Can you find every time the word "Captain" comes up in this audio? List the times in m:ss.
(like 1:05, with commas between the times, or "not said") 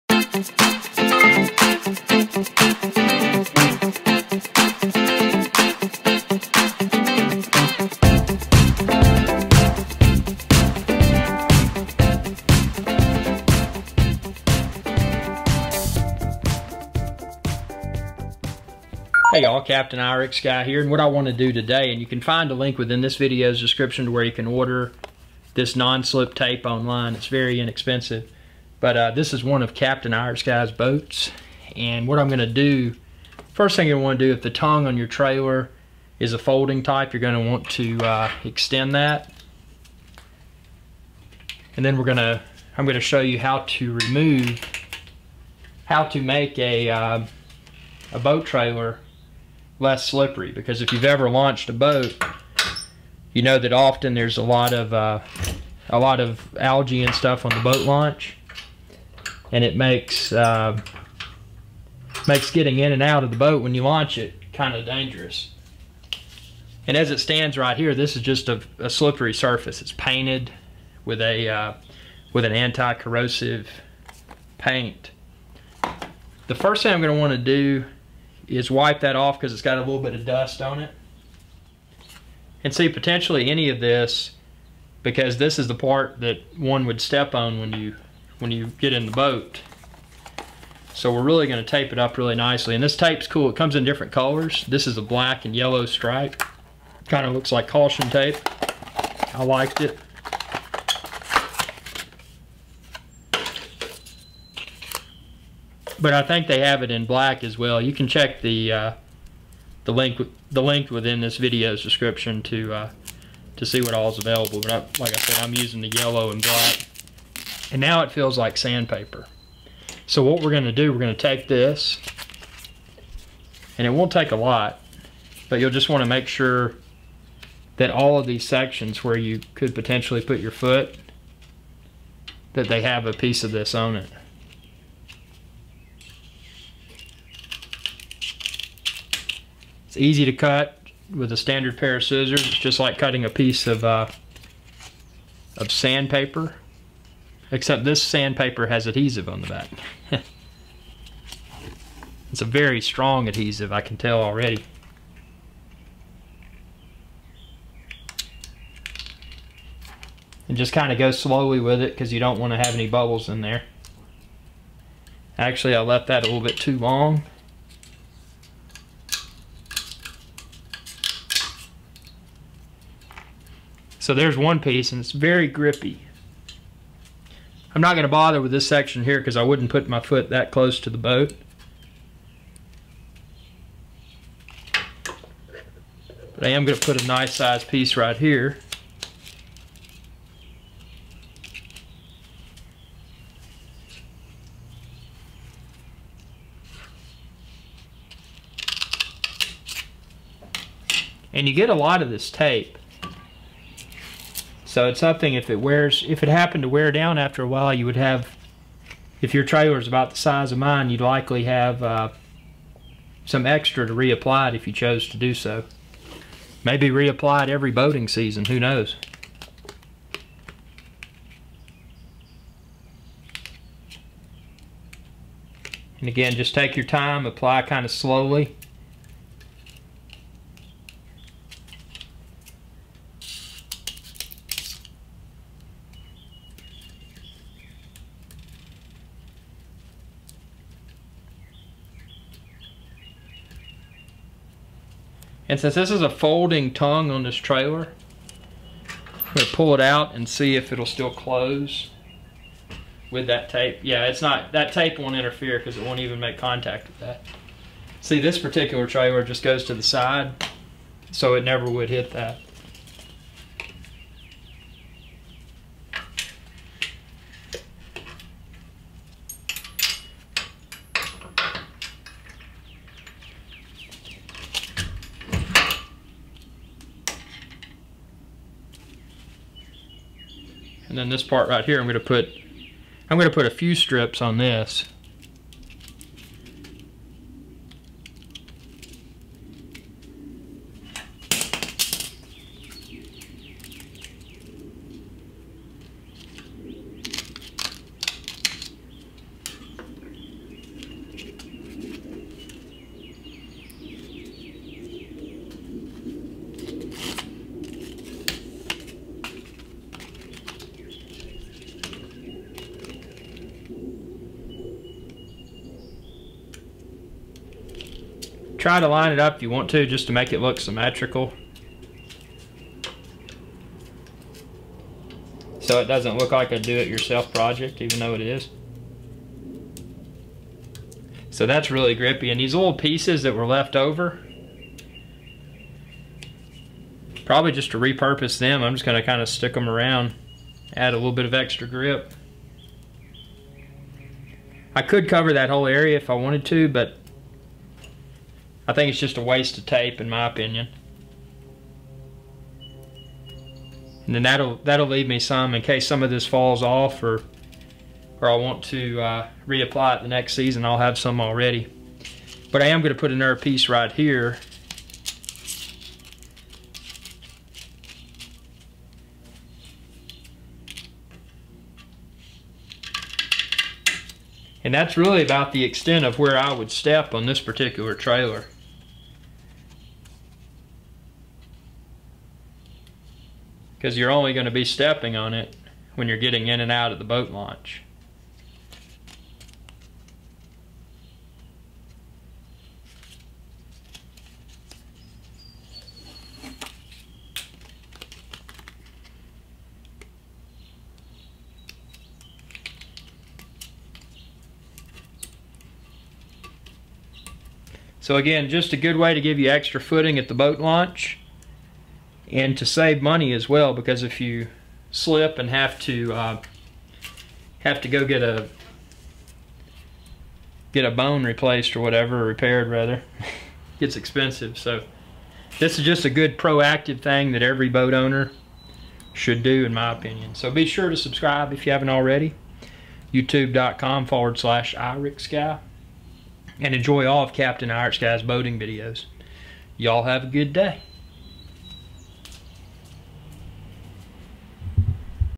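0:19, 0:29, 7:17.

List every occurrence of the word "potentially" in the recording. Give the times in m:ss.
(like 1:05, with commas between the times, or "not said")
1:22, 2:09.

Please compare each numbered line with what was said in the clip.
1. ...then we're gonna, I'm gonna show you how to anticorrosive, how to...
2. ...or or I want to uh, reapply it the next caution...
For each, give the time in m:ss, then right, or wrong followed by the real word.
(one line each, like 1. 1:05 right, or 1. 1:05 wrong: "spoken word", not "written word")
1. 0:41 wrong: "remove", not "anticorrosive"
2. 5:57 wrong: "season", not "caution".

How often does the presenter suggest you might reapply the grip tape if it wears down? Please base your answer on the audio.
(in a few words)
Every boating season.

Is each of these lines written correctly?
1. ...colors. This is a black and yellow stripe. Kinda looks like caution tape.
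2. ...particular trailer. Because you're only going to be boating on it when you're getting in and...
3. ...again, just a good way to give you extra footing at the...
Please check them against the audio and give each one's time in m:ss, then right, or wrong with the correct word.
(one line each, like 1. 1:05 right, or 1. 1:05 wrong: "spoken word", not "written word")
1. 1:34 right
2. 6:17 wrong: "stepping", not "boating"
3. 6:48 right.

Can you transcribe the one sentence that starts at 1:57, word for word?
And now it feels like sandpaper.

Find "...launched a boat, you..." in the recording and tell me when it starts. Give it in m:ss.
0:51.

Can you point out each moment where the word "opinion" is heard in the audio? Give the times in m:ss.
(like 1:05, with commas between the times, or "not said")
5:50, 7:09.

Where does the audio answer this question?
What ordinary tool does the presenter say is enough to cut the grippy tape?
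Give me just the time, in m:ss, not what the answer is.
2:21.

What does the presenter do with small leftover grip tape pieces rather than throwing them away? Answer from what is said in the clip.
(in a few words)
Repurpose them.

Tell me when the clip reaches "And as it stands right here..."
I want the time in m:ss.
1:06.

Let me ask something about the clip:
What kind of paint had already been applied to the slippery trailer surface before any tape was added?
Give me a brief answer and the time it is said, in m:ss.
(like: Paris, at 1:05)
Anti-corrosive paint, at 1:12.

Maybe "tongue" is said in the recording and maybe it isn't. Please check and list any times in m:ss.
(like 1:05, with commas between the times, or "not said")
0:34, 4:06.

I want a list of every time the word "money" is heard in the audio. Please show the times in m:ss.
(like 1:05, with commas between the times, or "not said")
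6:52.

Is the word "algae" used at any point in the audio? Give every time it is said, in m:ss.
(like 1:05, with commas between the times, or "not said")
0:56.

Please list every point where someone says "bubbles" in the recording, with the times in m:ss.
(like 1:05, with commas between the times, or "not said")
2:42.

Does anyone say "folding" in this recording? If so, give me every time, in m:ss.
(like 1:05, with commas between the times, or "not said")
0:36, 4:06.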